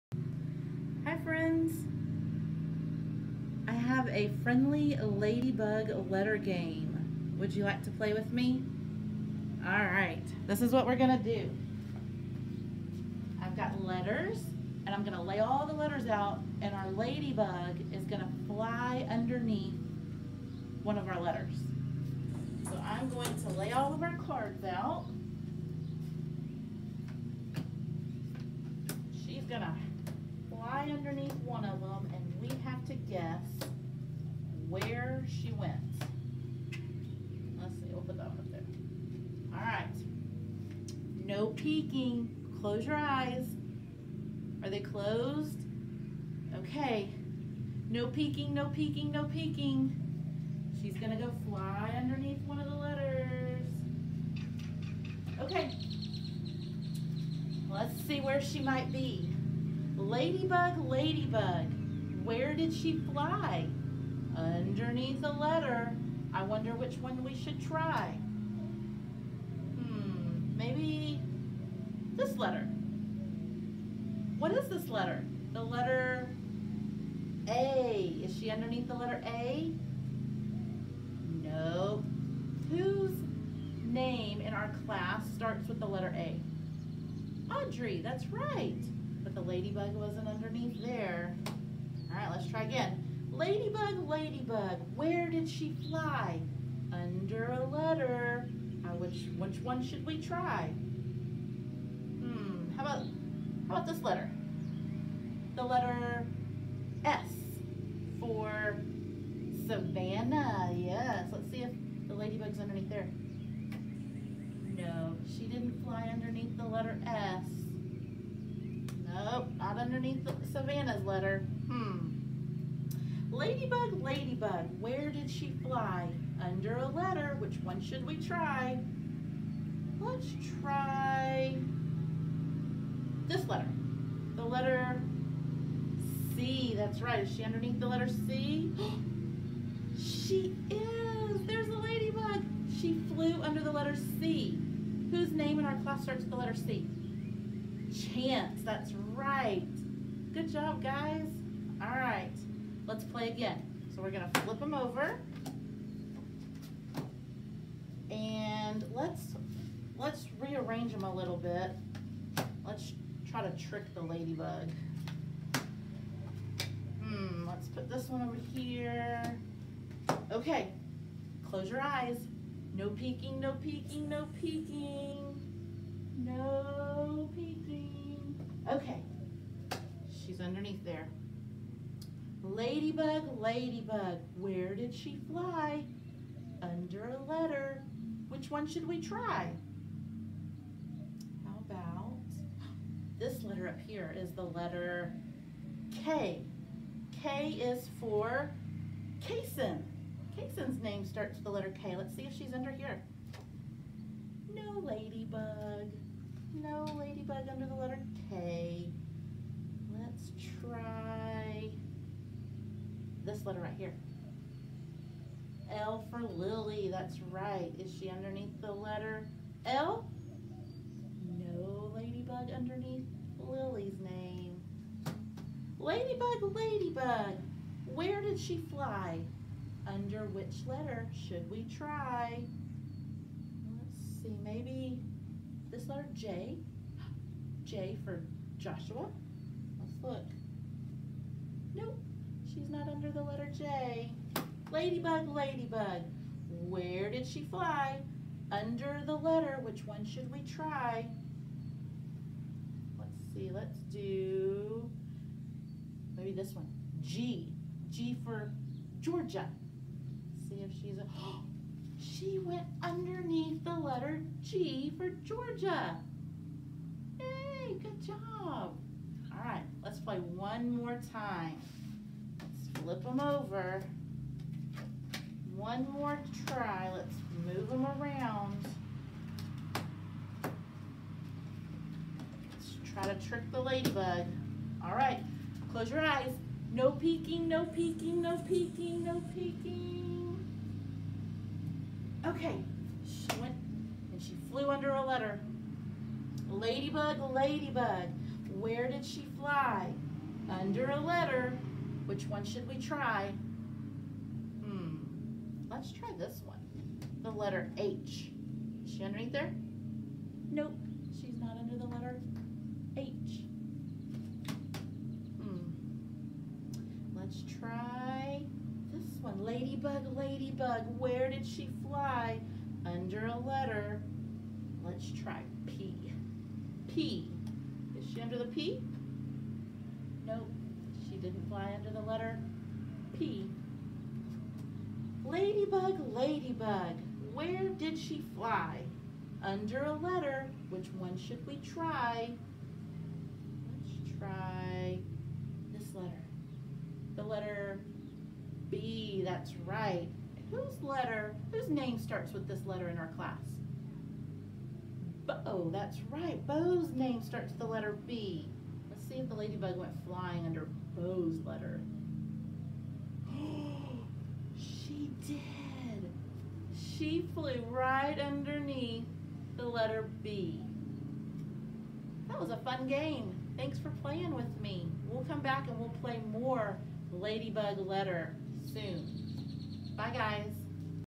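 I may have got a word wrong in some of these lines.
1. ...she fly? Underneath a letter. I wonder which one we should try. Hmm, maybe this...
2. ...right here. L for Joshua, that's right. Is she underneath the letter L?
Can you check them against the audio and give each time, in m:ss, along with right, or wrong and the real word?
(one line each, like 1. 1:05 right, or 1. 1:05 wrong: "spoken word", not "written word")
1. 1:02 right
2. 3:33 wrong: "Lily", not "Joshua".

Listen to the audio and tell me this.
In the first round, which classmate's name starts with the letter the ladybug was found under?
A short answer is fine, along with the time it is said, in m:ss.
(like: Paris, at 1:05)
Chance, at 2:27.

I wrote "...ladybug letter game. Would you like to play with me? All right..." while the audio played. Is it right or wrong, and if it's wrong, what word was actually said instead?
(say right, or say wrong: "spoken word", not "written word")
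right.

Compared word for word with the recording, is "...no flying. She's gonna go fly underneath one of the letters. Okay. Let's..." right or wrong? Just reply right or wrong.
wrong.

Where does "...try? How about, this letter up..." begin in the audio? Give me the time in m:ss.
3:09.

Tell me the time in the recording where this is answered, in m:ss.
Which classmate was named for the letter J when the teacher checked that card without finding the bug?
3:58.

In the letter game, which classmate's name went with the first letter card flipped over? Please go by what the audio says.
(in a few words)
Audrey.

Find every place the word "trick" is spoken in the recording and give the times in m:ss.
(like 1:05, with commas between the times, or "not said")
2:43, 4:43.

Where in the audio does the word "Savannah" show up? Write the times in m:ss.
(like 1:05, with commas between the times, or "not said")
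1:49, 2:00.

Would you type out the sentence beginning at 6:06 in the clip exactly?
She flew right underneath the letter B.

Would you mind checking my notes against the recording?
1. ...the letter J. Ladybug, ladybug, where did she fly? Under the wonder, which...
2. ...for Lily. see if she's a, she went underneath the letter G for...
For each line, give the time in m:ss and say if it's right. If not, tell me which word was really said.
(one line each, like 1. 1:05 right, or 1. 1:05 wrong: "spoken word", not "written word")
1. 4:03 wrong: "letter", not "wonder"
2. 4:18 wrong: "Georgia", not "Lily".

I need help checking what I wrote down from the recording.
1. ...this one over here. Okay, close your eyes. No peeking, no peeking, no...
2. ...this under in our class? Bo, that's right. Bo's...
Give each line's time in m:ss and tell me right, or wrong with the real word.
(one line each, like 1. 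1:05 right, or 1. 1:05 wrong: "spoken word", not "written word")
1. 2:47 right
2. 5:52 wrong: "letter", not "under".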